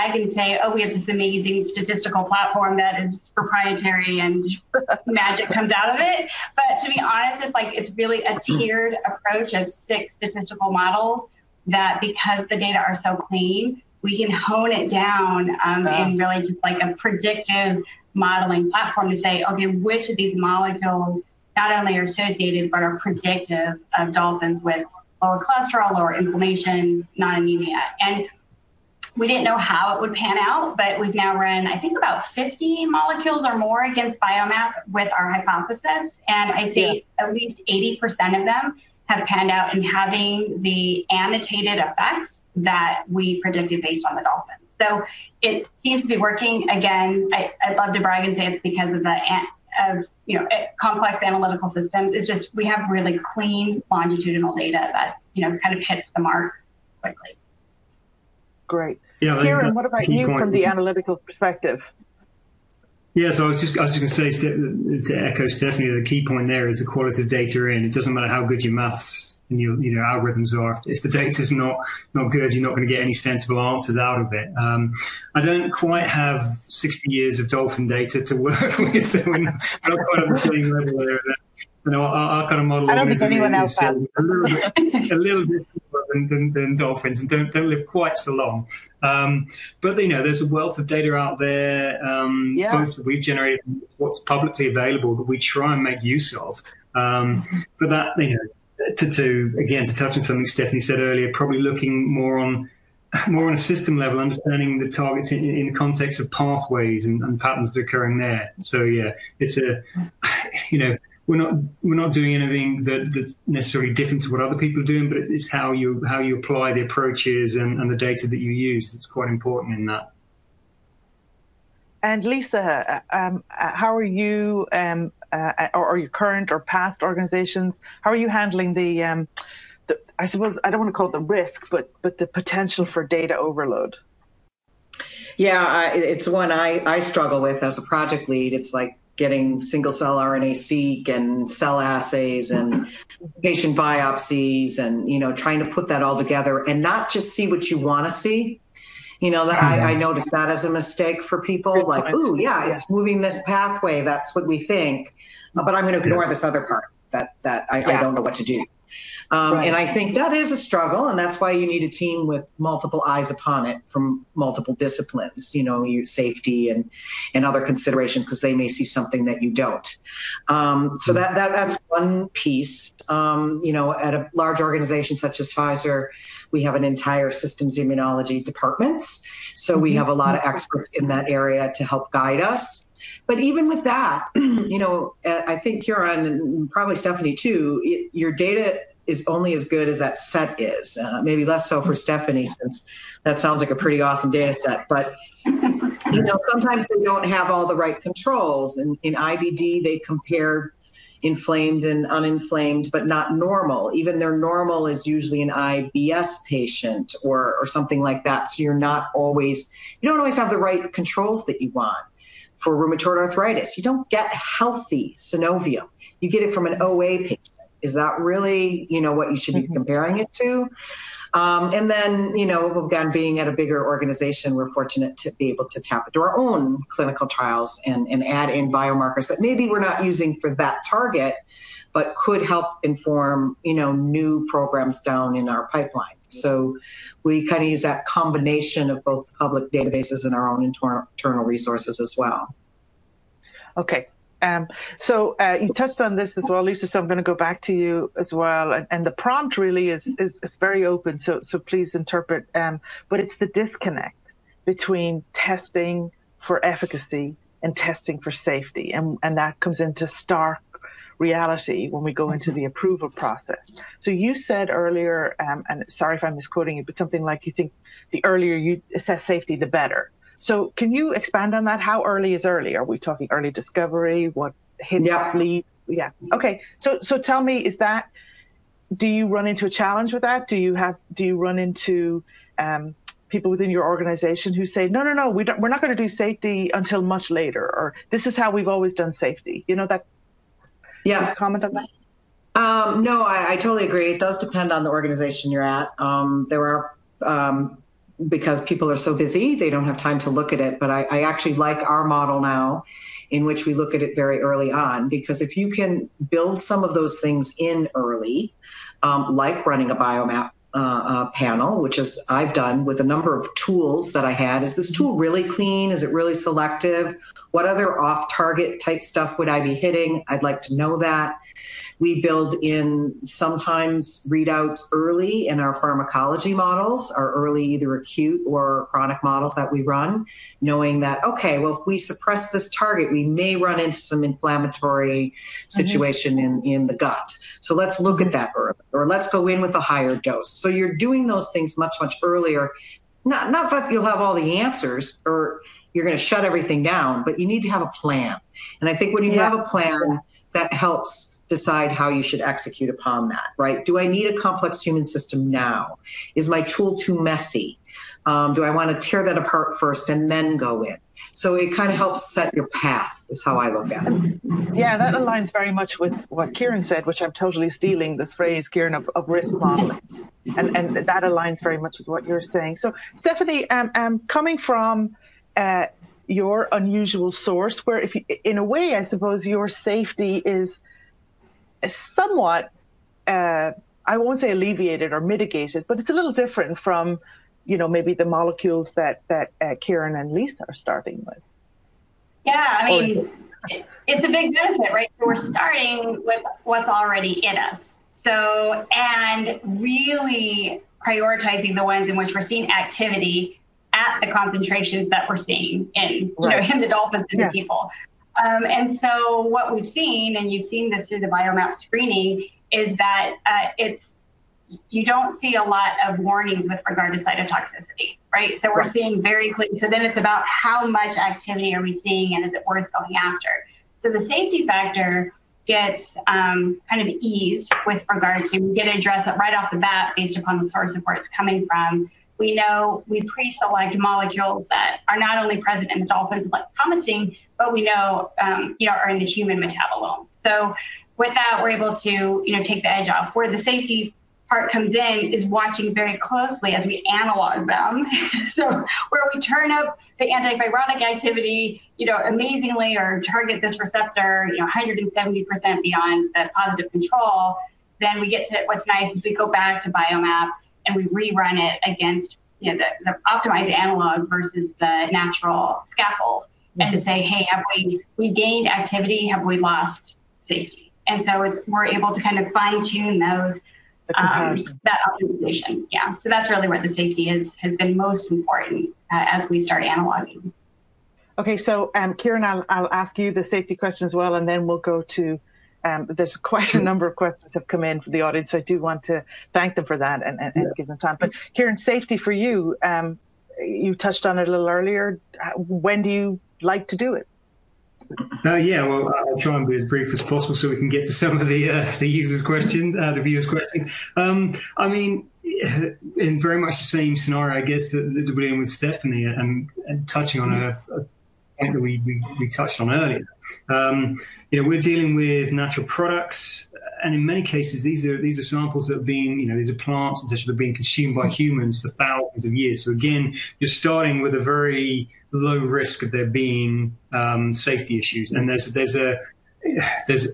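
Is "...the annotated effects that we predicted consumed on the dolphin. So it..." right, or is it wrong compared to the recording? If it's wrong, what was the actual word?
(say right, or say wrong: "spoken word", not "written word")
wrong: "based", not "consumed".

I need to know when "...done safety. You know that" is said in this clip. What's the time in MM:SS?
04:48.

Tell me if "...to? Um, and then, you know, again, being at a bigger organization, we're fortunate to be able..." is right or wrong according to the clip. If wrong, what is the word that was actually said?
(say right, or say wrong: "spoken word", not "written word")
right.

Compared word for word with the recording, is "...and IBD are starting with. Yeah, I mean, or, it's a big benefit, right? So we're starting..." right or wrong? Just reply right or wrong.
wrong.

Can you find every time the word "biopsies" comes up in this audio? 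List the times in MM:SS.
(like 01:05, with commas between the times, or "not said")
02:23.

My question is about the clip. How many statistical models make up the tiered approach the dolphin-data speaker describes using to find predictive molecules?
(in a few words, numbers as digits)
6.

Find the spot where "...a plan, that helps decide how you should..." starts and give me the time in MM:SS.
05:49.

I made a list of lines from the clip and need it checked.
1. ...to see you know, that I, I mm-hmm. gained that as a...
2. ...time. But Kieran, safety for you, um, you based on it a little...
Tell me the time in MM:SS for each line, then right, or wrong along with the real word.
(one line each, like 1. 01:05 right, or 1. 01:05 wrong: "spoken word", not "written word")
1. 02:28 wrong: "noticed", not "gained"
2. 08:10 wrong: "touched", not "based".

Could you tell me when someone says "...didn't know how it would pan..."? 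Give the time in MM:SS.
00:29.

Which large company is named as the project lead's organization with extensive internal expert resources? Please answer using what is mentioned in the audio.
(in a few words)
Pfizer.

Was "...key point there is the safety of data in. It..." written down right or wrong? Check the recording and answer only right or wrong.
wrong.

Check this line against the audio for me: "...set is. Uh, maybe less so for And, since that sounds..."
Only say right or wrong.
wrong.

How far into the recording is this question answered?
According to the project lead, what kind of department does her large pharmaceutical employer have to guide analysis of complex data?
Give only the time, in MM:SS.
02:57.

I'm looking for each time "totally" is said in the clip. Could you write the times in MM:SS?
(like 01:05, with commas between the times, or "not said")
04:53, 06:07.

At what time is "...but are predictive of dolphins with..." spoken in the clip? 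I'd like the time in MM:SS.
00:22.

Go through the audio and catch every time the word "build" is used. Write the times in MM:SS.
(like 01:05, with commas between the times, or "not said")
05:06, 05:22.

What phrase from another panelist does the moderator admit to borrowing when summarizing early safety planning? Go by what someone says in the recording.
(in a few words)
risk modeling.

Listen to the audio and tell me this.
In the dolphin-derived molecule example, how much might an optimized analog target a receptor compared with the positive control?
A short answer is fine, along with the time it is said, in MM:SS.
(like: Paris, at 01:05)
170%, at 07:34.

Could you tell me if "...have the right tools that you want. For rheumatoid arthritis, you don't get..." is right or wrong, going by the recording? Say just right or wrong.
wrong.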